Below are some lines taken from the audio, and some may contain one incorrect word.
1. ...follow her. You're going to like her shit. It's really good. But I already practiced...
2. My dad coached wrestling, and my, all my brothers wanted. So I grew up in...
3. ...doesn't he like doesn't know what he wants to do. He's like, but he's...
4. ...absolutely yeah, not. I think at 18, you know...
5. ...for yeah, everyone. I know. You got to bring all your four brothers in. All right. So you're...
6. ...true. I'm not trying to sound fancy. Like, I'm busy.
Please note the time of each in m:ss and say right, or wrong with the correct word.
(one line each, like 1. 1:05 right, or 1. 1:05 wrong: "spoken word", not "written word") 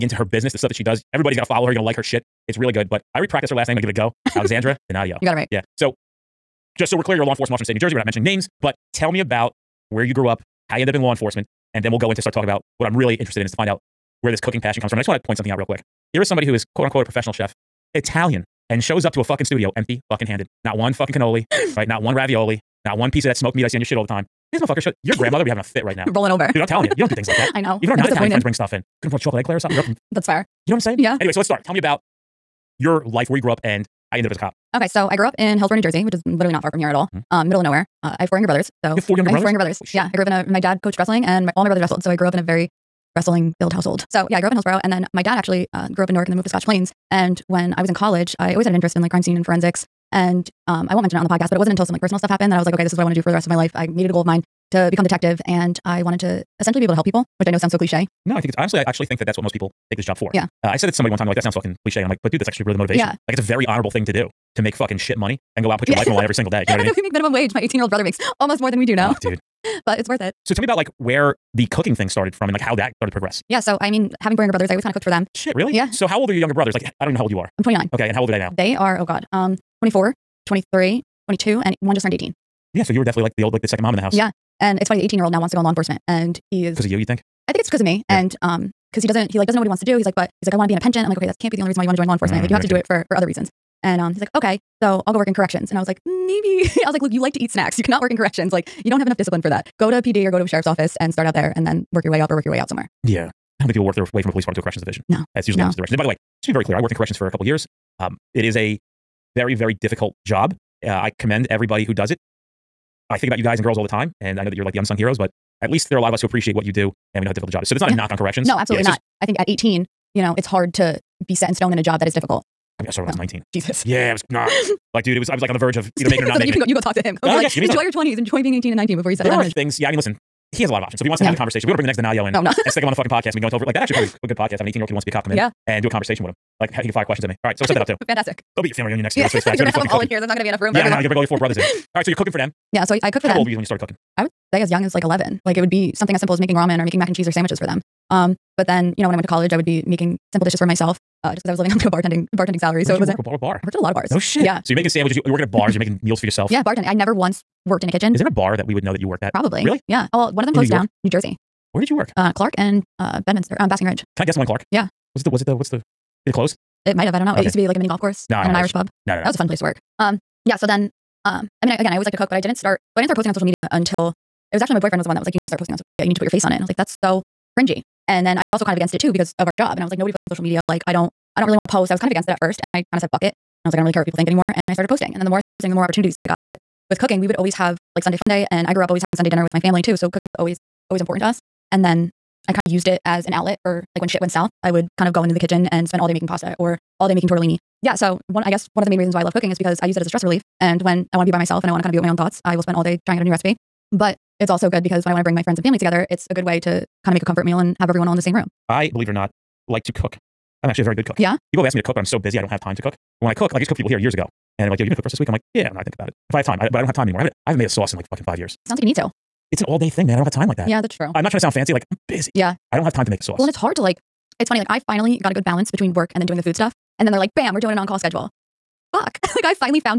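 1. 0:01 right
2. 0:40 wrong: "wrestled", not "wanted"
3. 1:29 right
4. 1:58 right
5. 2:20 right
6. 3:40 right.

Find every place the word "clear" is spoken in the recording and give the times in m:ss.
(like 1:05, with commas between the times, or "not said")
0:07, 1:46.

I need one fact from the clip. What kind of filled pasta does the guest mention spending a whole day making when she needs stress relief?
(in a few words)
Tortellini.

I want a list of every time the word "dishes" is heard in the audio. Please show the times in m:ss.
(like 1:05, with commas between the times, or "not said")
2:30.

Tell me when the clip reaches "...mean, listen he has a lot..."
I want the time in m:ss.
2:09.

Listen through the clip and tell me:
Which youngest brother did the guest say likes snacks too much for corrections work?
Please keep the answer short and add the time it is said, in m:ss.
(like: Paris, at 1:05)
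Luke, at 1:37.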